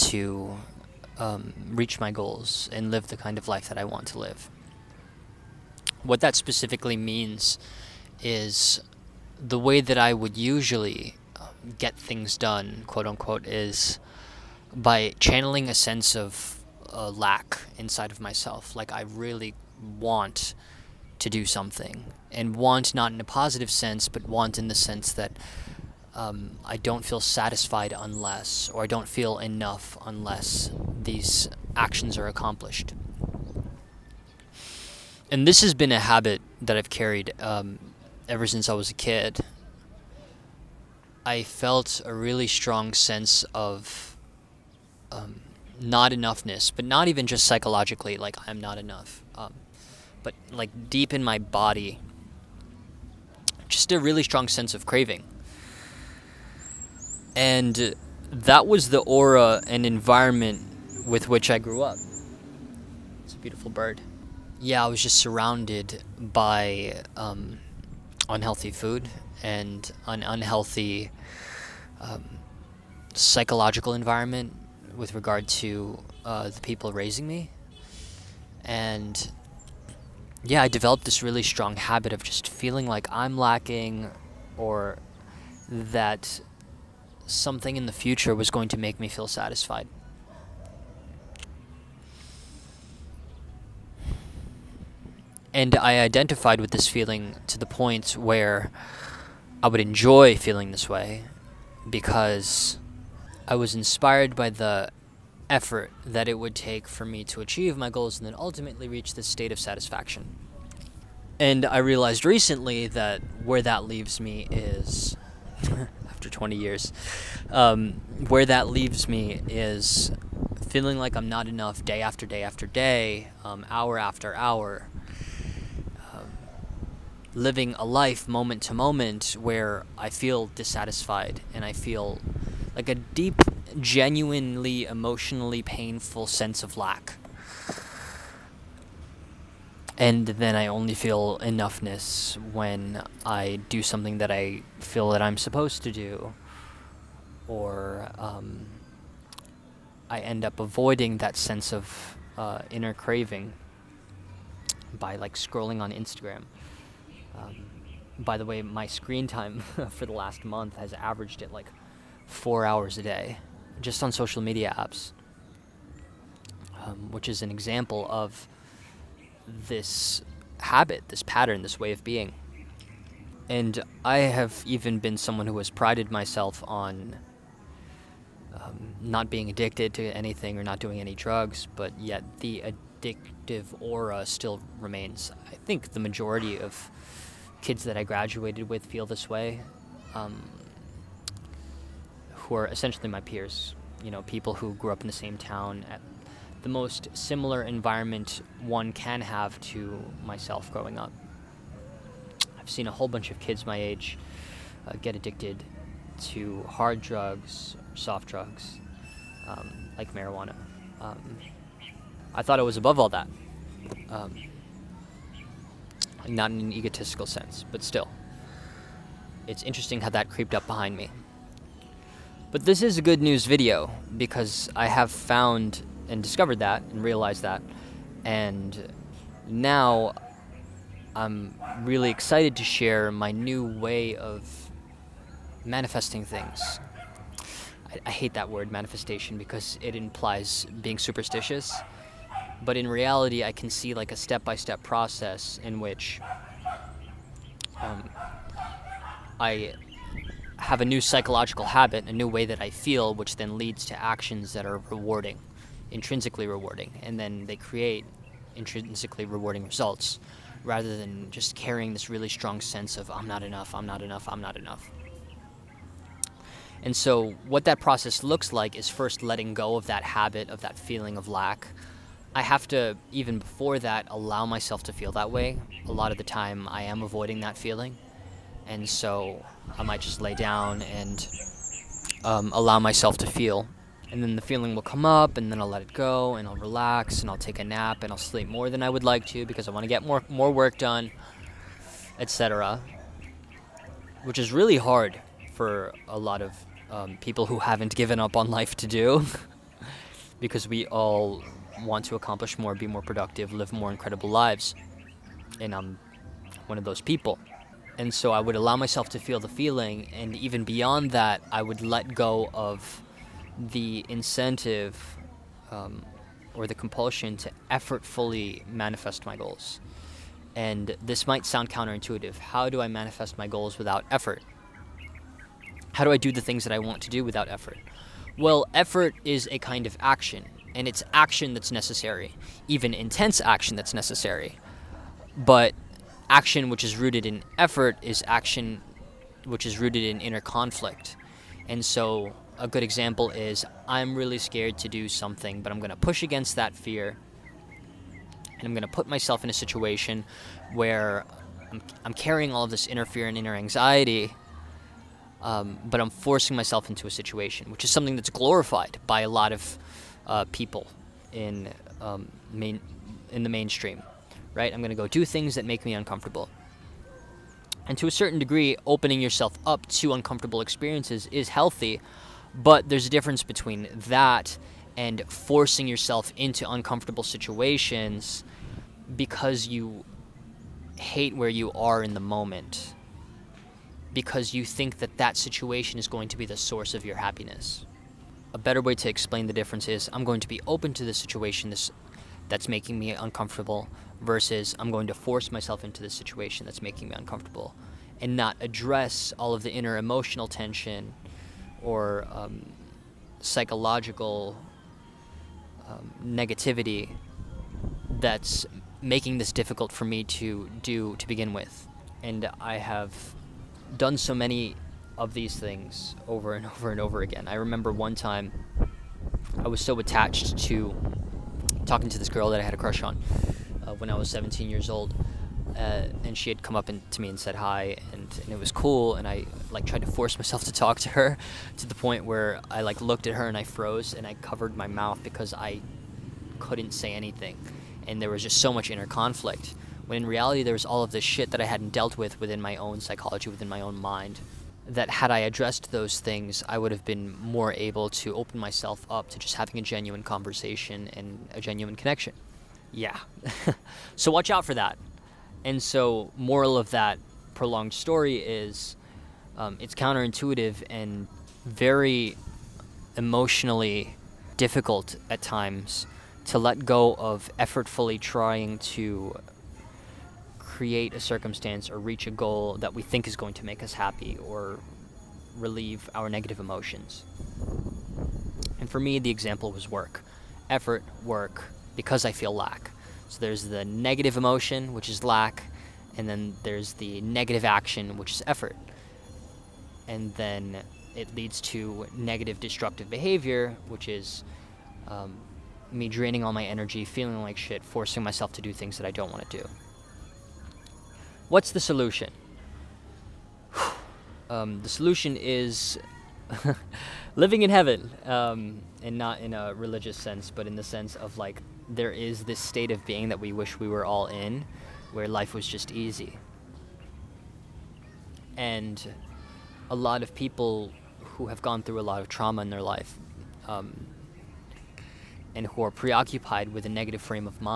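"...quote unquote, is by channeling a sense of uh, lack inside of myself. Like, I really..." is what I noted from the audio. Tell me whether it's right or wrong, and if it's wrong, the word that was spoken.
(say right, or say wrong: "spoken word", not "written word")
right.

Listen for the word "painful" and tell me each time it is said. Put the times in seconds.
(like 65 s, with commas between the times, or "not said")
135 s.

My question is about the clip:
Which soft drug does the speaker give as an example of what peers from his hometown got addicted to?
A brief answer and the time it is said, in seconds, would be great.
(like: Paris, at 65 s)
marijuana, at 210 s.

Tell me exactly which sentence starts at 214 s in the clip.
Um, not in an egotistical sense, but still.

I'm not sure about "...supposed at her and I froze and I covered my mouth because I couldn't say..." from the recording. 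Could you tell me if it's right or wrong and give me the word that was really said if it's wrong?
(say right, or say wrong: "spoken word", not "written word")
wrong: "looked", not "supposed".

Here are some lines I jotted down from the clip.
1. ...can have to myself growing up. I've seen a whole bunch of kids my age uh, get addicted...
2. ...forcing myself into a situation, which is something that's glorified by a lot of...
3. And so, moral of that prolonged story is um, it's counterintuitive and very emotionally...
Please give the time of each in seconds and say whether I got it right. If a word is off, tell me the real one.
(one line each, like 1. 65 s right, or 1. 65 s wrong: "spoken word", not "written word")
1. 198 s right
2. 356 s right
3. 455 s right.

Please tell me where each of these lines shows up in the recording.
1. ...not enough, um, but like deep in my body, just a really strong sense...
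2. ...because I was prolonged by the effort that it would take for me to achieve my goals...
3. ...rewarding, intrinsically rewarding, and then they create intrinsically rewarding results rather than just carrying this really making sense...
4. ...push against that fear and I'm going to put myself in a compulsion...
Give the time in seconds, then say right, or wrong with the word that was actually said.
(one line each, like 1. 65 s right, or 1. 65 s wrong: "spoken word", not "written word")
1. 48 s right
2. 101 s wrong: "inspired", not "prolonged"
3. 254 s wrong: "strong", not "making"
4. 345 s wrong: "situation", not "compulsion".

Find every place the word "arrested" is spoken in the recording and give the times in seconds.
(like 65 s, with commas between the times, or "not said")
not said.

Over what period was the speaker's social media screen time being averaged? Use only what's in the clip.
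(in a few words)
last month.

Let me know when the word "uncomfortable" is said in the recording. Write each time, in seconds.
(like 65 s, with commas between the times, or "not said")
365 s, 370 s, 376 s, 393 s, 397 s.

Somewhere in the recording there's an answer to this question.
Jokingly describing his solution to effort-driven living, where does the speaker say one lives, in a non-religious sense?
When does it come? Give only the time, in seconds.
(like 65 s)
507 s.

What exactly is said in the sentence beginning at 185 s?
I think the majority of kids that I graduated with feel this way, um, who are essentially my peers.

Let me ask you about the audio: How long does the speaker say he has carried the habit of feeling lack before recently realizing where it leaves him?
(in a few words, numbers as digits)
20 years.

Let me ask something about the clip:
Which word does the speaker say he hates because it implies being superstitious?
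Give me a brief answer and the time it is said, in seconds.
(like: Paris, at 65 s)
manifestation, at 238 s.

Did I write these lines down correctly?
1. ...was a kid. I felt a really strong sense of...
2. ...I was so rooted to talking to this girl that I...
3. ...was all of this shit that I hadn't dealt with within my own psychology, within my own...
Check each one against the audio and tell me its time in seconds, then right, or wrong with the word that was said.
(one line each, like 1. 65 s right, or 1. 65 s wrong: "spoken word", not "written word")
1. 38 s right
2. 419 s wrong: "attached", not "rooted"
3. 440 s right.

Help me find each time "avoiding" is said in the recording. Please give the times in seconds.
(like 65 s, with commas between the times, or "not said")
150 s, 277 s.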